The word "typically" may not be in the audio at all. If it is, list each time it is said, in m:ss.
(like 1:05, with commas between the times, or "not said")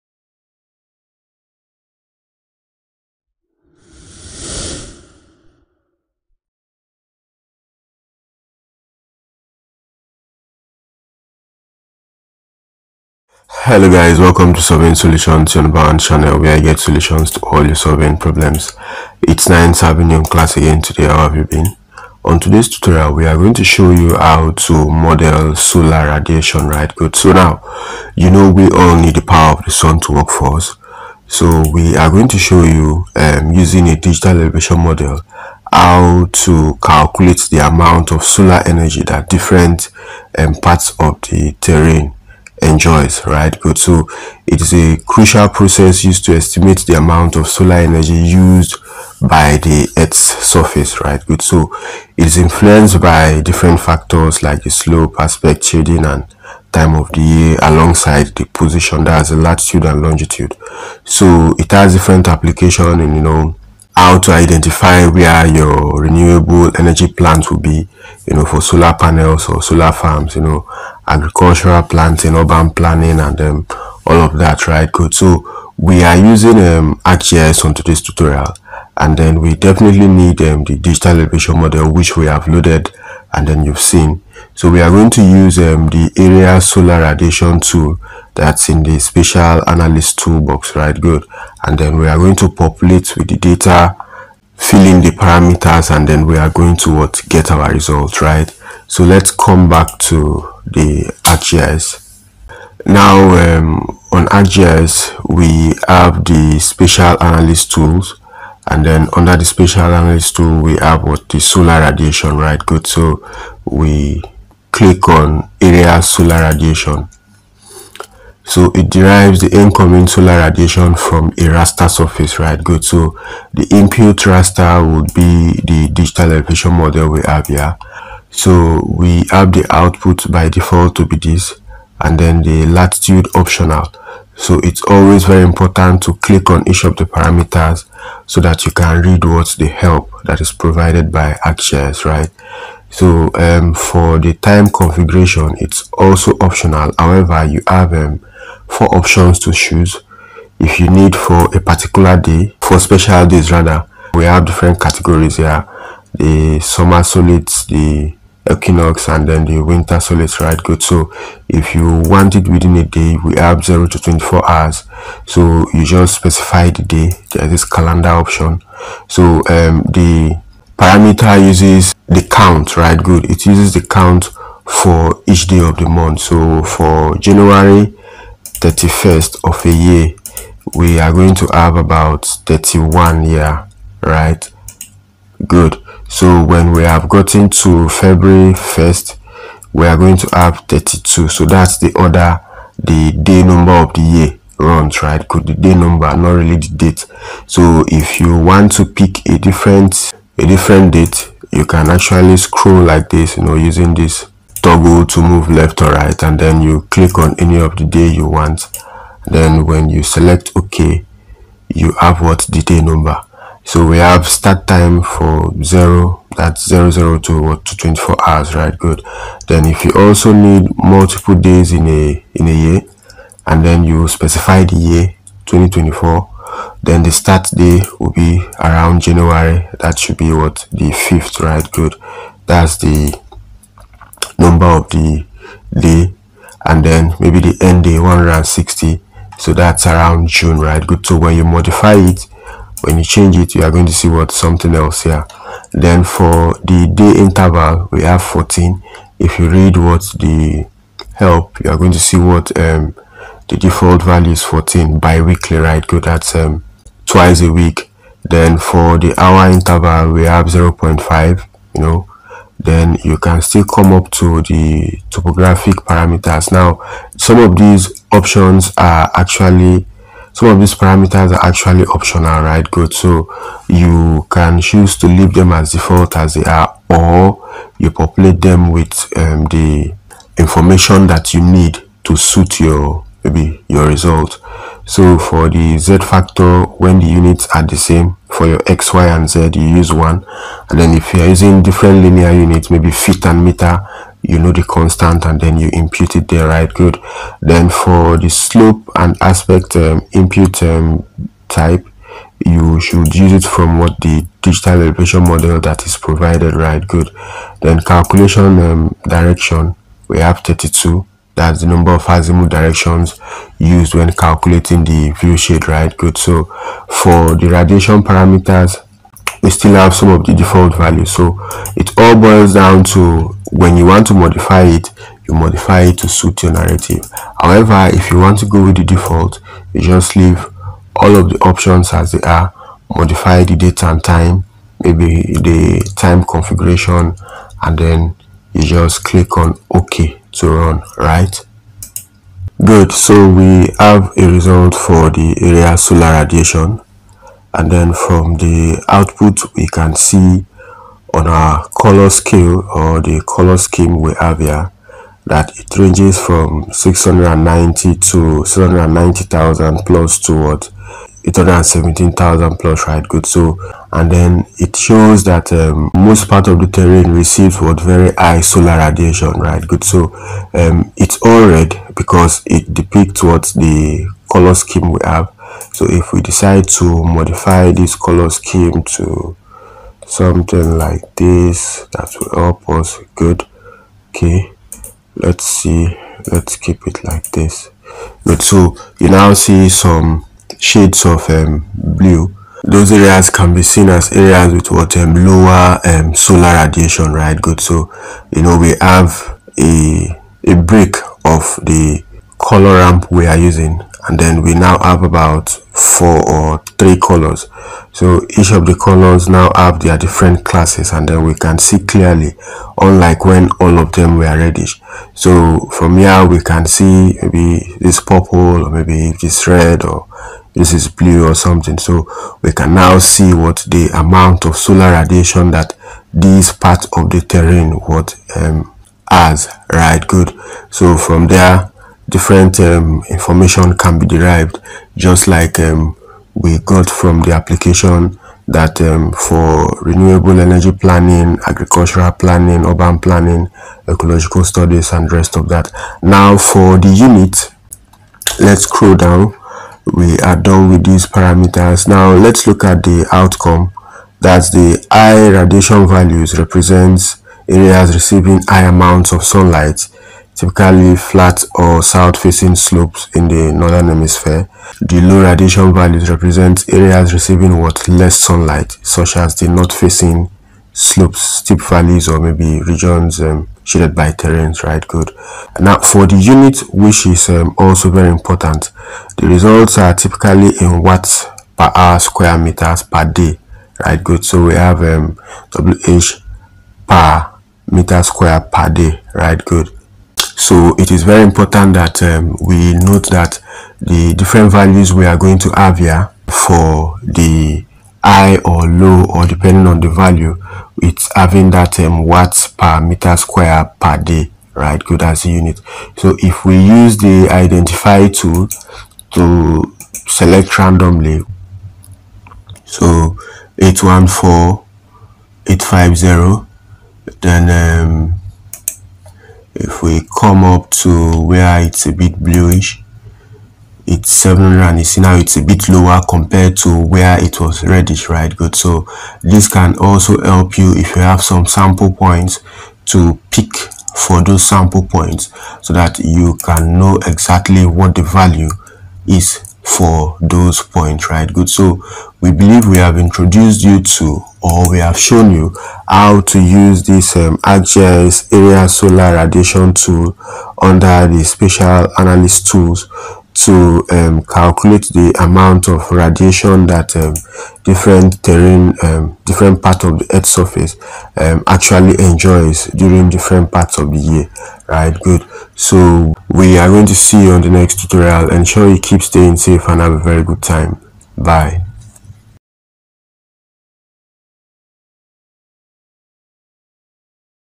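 7:40, 7:59.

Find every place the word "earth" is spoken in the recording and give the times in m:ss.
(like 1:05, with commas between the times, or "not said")
0:49, 9:20.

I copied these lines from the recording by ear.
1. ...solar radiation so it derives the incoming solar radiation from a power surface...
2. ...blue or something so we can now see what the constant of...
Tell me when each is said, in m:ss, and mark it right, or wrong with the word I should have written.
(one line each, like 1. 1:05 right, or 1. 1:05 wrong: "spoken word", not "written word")
1. 1:56 wrong: "raster", not "power"
2. 7:00 wrong: "amount", not "constant".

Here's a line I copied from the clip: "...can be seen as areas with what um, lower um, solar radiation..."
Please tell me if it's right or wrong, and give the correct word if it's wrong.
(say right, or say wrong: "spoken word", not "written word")
right.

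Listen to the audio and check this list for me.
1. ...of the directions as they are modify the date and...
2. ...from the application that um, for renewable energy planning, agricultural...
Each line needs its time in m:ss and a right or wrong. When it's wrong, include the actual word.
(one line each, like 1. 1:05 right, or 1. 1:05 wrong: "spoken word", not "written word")
1. 5:31 wrong: "options", not "directions"
2. 7:16 right.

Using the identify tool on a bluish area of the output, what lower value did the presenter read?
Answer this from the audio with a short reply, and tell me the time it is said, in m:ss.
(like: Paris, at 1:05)
700, at 8:44.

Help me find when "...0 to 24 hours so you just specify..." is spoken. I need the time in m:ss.
2:43.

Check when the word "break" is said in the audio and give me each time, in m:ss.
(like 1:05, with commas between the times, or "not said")
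6:40.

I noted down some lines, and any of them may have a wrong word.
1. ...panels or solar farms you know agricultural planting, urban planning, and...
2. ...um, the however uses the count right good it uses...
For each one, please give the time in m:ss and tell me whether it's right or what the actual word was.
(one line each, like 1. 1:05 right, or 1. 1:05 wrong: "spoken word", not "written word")
1. 1:08 right
2. 2:49 wrong: "parameter", not "however".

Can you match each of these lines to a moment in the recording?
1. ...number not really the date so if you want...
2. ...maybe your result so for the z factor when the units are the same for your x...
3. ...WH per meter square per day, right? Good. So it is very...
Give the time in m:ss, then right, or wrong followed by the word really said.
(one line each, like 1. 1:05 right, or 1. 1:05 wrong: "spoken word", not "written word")
1. 3:15 right
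2. 4:43 right
3. 8:05 right.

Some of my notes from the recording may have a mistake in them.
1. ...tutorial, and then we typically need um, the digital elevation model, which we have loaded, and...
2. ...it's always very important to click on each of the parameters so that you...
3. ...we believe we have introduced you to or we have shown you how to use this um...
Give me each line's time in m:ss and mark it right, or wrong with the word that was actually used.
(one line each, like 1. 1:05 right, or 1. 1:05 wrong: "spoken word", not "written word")
1. 1:18 wrong: "definitely", not "typically"
2. 2:14 right
3. 9:02 right.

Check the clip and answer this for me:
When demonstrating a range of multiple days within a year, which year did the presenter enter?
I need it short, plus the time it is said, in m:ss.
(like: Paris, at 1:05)
2024, at 3:45.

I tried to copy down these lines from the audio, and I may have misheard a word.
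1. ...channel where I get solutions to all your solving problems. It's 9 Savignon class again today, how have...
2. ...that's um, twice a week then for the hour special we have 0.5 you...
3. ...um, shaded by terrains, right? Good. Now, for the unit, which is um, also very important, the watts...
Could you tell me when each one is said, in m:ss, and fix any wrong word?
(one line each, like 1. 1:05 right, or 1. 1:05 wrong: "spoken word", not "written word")
1. 0:15 right
2. 4:16 wrong: "interval", not "special"
3. 7:53 wrong: "results", not "watts".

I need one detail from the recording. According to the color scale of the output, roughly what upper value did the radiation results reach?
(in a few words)
817,000.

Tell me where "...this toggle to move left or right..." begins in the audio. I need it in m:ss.
3:23.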